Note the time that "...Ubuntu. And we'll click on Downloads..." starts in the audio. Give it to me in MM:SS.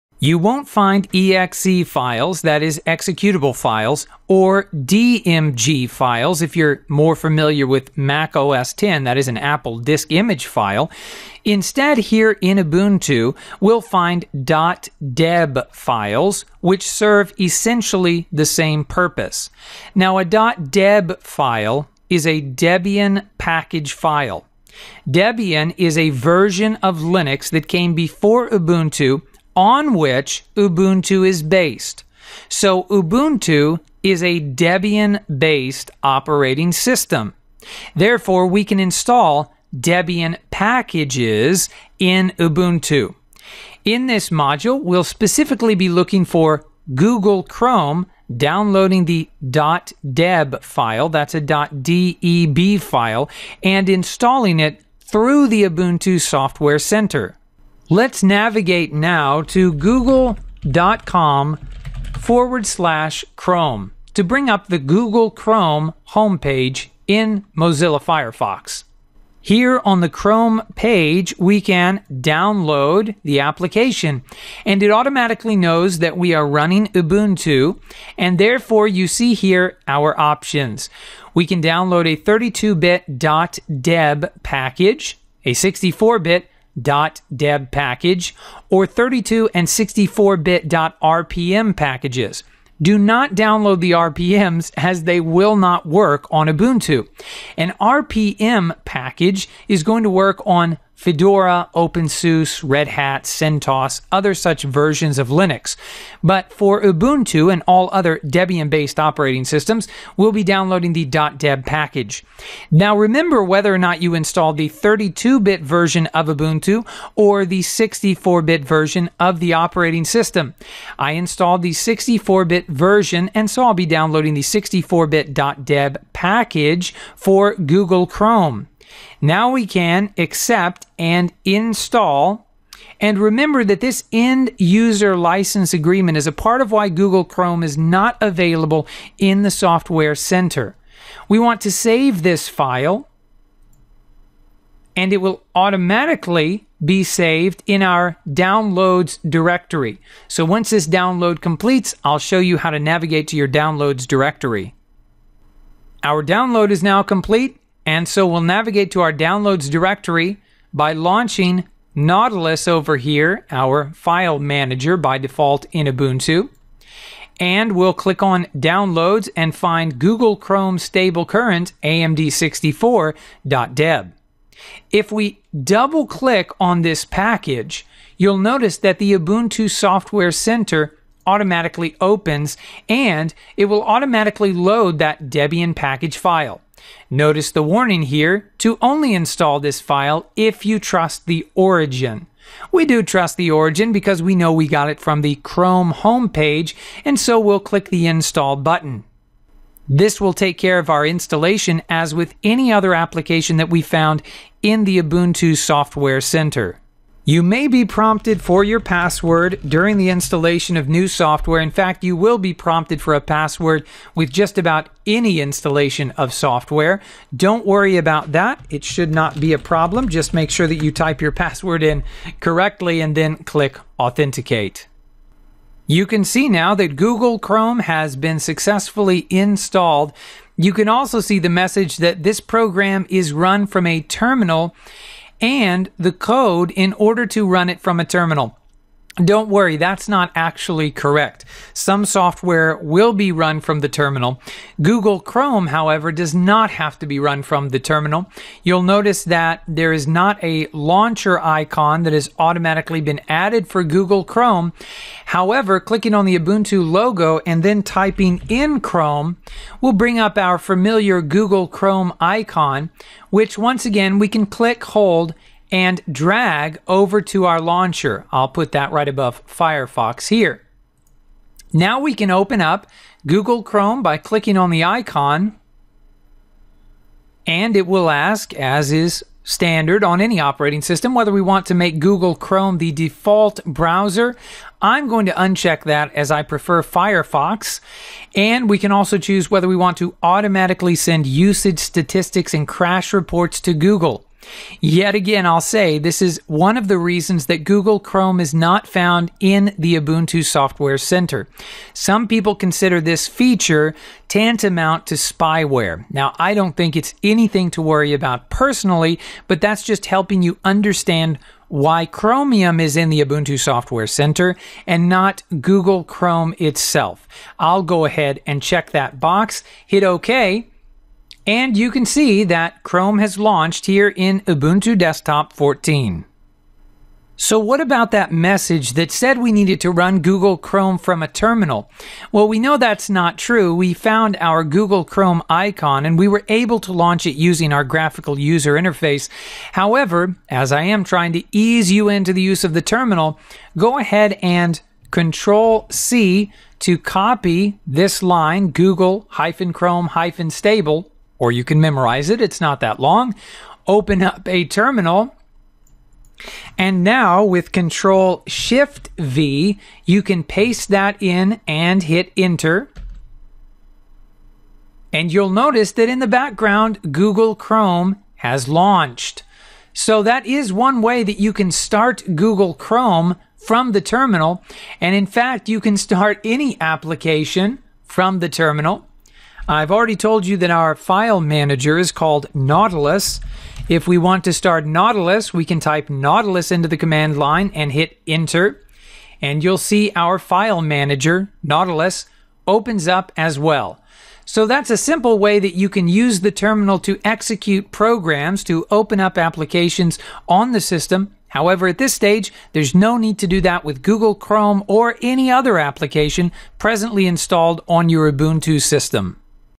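02:45.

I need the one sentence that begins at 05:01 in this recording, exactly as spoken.
Some people consider this feature tantamount to spyware.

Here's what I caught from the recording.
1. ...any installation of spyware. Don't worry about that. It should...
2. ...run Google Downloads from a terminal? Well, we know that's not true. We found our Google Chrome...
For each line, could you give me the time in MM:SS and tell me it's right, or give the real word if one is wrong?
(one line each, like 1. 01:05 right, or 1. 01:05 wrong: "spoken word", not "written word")
1. 03:35 wrong: "software", not "spyware"
2. 05:29 wrong: "Chrome", not "Downloads".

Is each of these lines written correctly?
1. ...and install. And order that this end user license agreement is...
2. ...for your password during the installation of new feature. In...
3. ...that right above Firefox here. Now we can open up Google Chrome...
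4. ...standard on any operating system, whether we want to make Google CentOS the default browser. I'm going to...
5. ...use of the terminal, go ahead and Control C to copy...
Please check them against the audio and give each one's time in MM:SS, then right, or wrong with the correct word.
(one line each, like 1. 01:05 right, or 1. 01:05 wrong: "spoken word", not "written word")
1. 02:10 wrong: "remember", not "order"
2. 03:28 wrong: "software", not "feature"
3. 04:28 right
4. 04:39 wrong: "Chrome", not "CentOS"
5. 05:42 right.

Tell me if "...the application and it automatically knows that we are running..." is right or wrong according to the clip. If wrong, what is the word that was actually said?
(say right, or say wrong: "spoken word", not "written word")
right.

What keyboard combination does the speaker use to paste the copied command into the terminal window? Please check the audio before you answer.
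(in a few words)
Control Shift V.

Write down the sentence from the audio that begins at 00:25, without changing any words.
Debian is a version of Linux that came before Ubuntu on which Ubuntu is based.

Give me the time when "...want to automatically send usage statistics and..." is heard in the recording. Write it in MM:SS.
04:49.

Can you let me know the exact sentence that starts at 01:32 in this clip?
Do not download the RPMs as they will not work on Ubuntu.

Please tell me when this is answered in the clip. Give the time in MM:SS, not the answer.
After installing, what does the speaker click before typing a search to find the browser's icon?
04:16.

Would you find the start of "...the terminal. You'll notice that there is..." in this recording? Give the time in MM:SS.
04:07.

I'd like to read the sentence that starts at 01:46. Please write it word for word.
But for Ubuntu and all other Debian based operating systems, we'll be downloading the .deb package.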